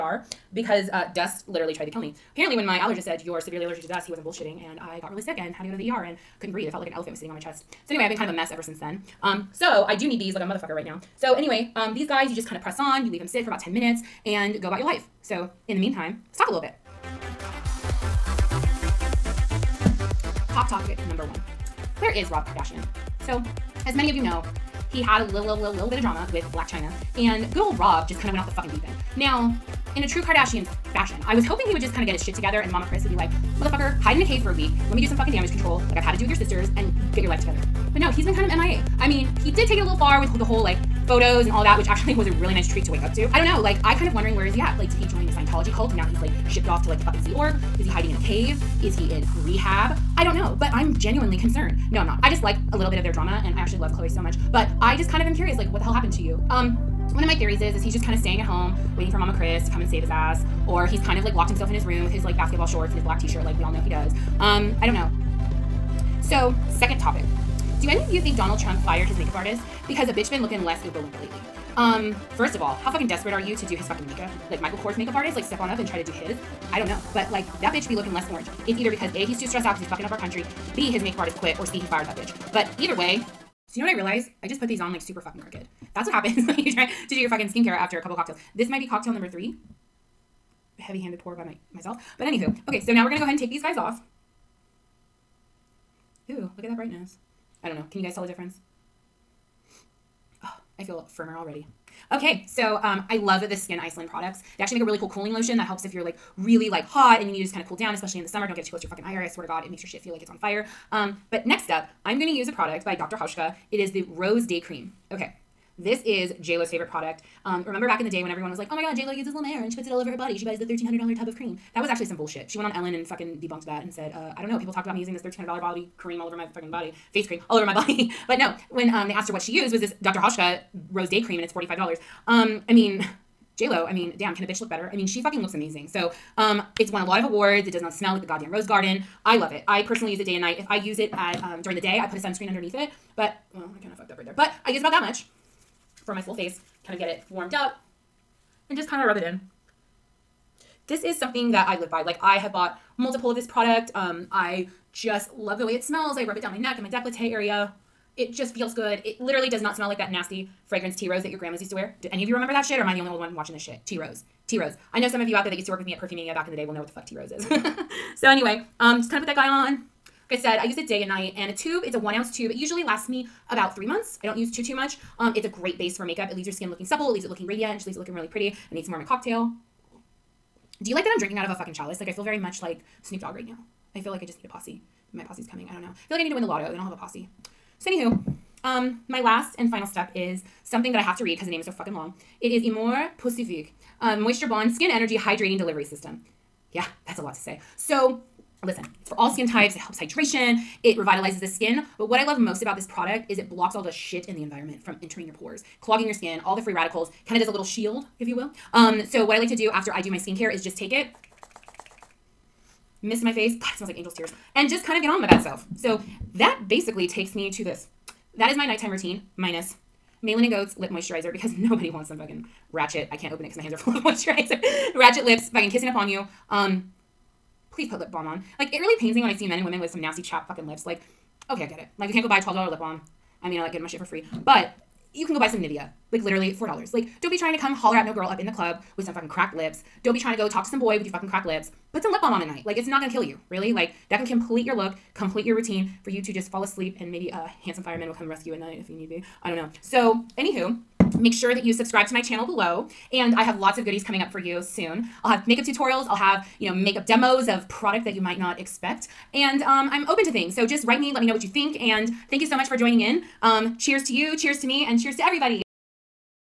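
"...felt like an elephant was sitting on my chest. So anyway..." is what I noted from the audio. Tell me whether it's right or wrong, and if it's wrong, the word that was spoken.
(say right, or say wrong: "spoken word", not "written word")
right.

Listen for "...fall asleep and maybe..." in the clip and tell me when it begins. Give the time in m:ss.
4:06.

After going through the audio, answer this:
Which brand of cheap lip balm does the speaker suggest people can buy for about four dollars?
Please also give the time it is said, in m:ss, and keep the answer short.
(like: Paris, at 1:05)
Nivea, at 3:55.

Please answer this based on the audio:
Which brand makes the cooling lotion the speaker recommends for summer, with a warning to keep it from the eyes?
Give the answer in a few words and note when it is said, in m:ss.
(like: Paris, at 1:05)
Skyn Iceland, at 1:43.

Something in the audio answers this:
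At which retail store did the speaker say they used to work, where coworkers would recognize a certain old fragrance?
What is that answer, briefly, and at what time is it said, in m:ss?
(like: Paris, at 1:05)
Perfumania, at 2:45.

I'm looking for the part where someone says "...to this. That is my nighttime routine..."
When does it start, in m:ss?
3:37.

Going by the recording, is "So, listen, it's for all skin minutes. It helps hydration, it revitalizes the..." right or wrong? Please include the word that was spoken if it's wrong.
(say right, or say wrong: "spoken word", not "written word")
wrong: "types", not "minutes".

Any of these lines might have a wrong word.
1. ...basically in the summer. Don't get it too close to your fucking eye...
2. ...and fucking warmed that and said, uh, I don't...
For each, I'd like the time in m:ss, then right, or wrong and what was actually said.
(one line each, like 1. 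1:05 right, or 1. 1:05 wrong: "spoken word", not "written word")
1. 1:47 wrong: "especially", not "basically"
2. 2:02 wrong: "debunked", not "warmed".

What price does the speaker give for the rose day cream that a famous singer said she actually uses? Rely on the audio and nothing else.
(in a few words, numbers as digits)
$45.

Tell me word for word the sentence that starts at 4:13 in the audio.
And I have lots of goodies coming up for you soon.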